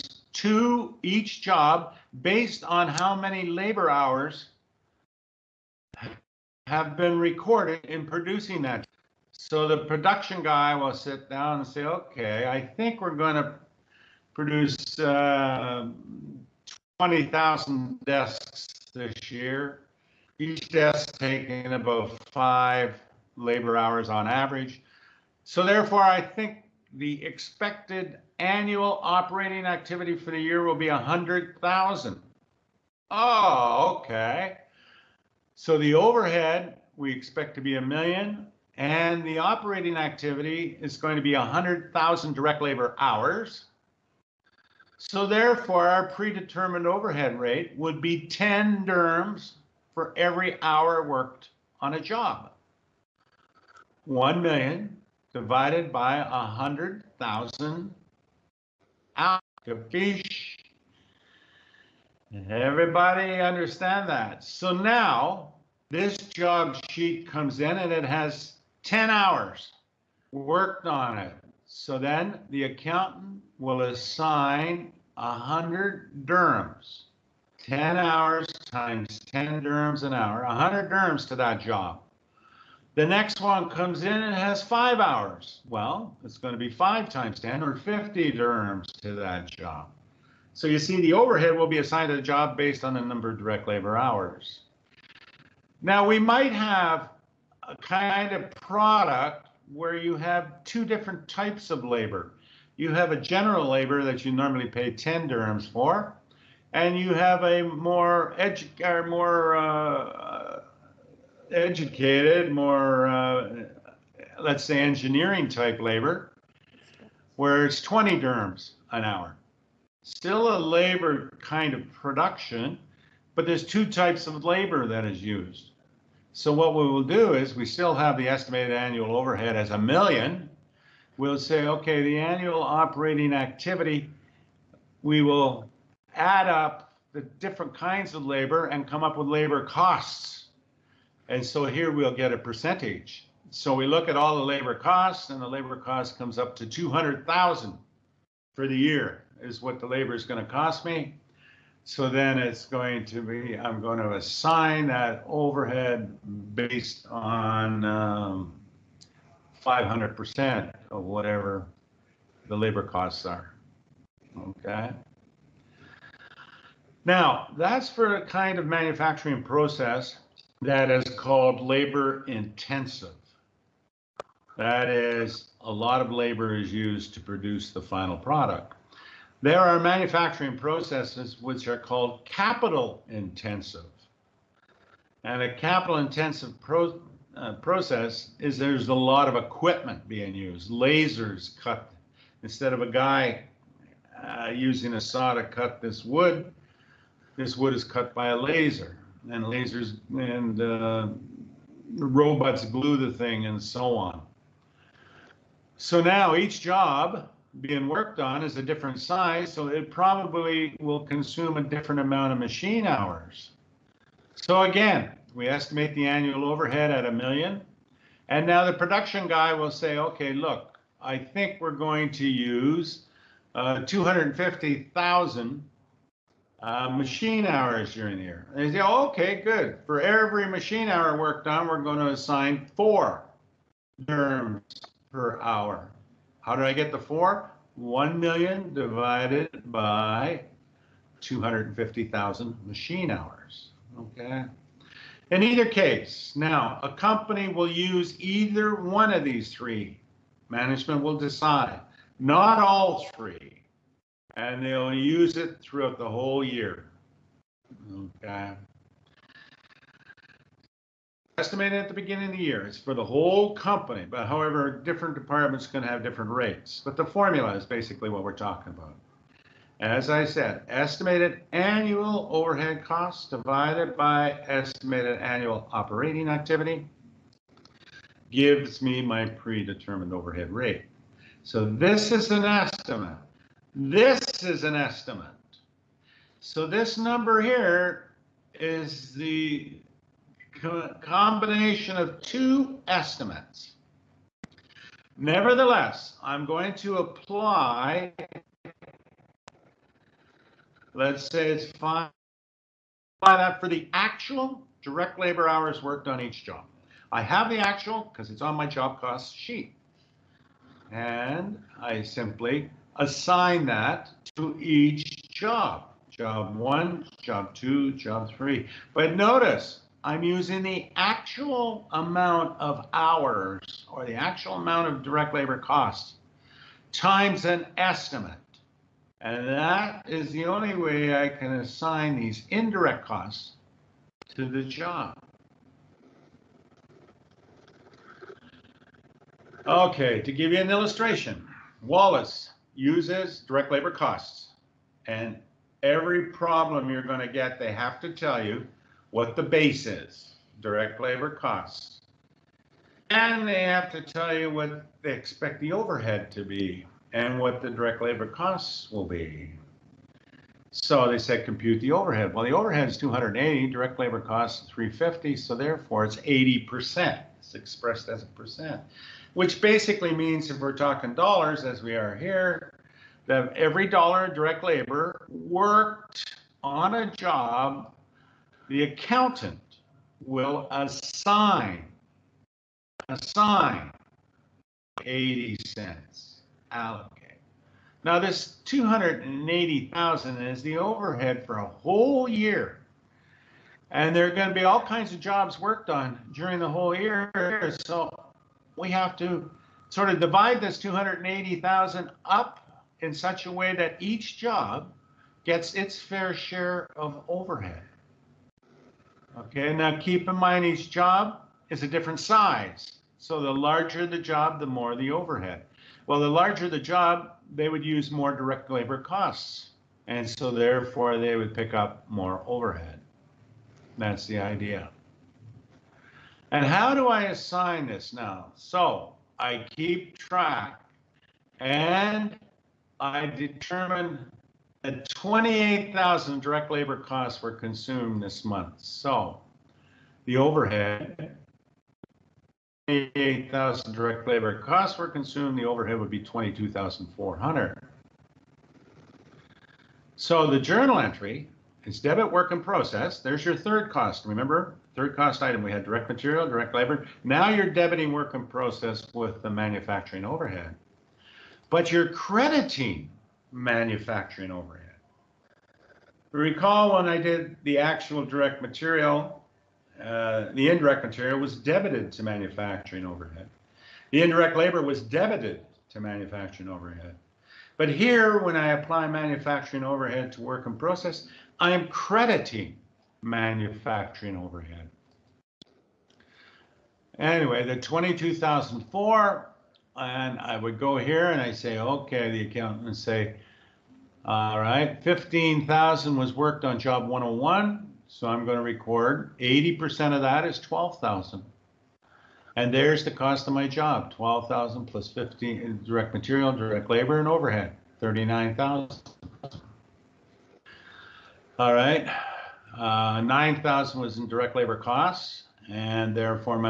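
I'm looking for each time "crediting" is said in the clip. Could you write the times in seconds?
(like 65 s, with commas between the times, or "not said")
462 s, 481 s.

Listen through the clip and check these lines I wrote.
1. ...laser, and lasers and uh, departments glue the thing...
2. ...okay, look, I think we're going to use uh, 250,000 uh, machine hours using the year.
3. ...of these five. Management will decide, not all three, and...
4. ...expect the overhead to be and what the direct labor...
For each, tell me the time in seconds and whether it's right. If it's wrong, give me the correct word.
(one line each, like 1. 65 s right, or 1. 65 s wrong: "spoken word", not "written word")
1. 198 s wrong: "robots", not "departments"
2. 219 s wrong: "during", not "using"
3. 249 s wrong: "three", not "five"
4. 355 s right.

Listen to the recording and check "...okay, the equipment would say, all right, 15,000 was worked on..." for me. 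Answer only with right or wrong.
wrong.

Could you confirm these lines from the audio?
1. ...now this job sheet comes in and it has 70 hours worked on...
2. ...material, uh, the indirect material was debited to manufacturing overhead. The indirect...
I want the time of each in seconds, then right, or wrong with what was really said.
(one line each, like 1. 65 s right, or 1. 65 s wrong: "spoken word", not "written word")
1. 64 s wrong: "10", not "70"
2. 468 s right.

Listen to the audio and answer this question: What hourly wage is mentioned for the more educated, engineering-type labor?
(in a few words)
20 dirhams.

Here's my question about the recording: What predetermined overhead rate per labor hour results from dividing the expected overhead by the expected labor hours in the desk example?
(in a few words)
10 dirhams.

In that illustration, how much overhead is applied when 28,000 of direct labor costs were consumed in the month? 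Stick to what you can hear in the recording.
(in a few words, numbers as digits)
22,400.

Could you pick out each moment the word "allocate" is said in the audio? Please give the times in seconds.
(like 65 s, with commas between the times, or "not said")
386 s.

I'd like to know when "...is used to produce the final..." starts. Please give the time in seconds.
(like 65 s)
176 s.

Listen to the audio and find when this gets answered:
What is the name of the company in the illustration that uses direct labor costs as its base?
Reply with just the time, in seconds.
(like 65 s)
341 s.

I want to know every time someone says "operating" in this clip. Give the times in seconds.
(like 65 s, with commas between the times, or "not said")
29 s, 39 s, 132 s, 275 s.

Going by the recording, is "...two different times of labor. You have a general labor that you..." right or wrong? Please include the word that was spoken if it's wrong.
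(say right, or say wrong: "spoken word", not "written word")
wrong: "types", not "times".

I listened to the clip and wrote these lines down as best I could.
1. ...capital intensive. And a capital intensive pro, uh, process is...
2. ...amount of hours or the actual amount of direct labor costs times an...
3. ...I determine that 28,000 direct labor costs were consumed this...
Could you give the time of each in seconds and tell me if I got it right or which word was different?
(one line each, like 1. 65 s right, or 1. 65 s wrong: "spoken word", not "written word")
1. 182 s right
2. 321 s right
3. 432 s right.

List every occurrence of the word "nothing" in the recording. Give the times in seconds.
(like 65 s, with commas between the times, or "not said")
not said.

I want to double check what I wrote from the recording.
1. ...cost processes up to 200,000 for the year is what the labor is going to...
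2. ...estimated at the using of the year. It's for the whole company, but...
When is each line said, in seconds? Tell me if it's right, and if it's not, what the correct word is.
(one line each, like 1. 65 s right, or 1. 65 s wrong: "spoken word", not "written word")
1. 145 s wrong: "comes", not "processes"
2. 261 s wrong: "beginning", not "using".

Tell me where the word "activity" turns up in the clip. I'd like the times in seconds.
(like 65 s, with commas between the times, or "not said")
29 s, 39 s, 133 s, 276 s.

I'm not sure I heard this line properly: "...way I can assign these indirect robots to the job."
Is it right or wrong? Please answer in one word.
wrong.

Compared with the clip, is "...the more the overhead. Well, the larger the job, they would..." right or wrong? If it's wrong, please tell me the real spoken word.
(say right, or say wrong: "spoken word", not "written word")
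right.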